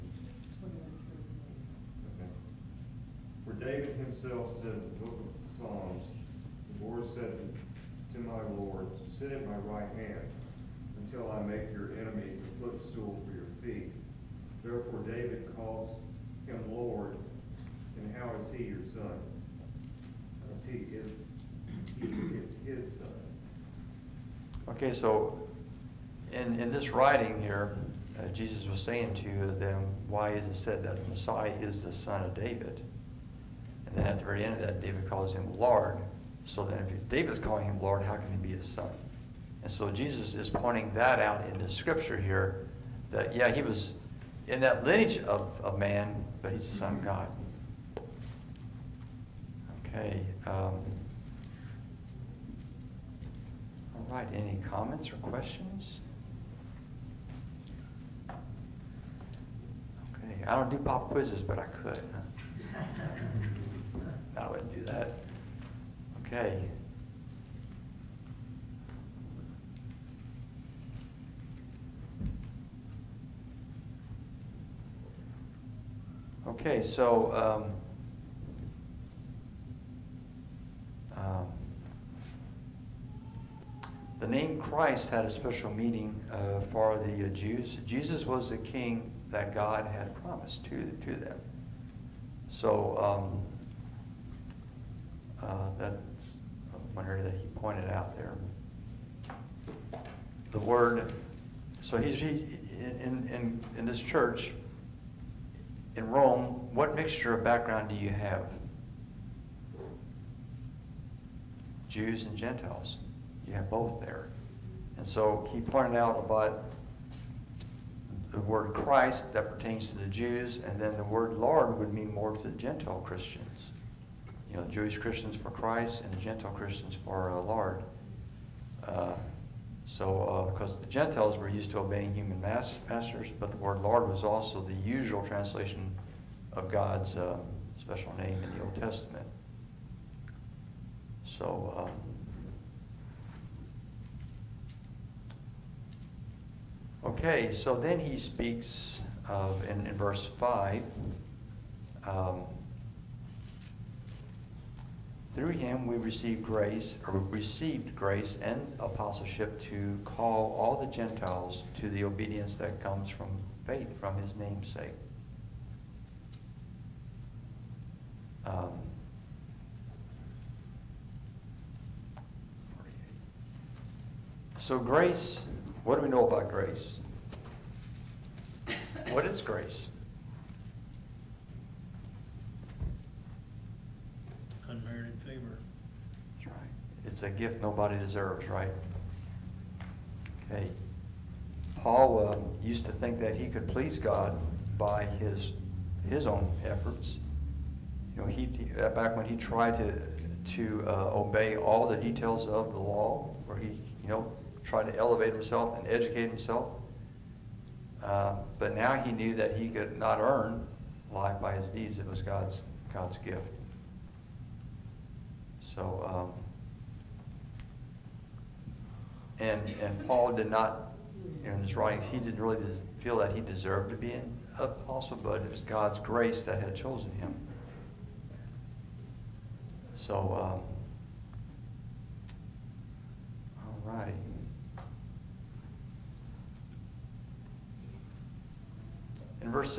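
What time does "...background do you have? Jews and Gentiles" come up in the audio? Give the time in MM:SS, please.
01:47.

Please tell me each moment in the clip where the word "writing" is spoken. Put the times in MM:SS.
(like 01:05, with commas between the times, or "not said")
00:26, 03:41.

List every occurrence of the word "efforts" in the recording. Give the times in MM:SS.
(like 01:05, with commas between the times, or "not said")
03:16.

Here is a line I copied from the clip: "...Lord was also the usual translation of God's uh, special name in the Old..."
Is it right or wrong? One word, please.
right.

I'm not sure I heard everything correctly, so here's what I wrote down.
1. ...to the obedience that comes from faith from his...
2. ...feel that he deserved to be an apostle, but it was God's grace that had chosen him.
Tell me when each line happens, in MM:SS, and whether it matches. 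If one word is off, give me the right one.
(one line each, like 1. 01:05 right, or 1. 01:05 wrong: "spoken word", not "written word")
1. 02:41 right
2. 03:43 right.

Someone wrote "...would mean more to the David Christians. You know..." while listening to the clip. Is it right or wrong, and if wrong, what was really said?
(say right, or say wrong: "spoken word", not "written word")
wrong: "Gentile", not "David".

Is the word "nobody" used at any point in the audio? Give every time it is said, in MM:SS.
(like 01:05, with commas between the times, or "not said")
03:07.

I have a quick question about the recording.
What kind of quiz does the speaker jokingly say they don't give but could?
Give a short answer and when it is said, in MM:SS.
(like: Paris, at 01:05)
Pop quizzes, at 01:00.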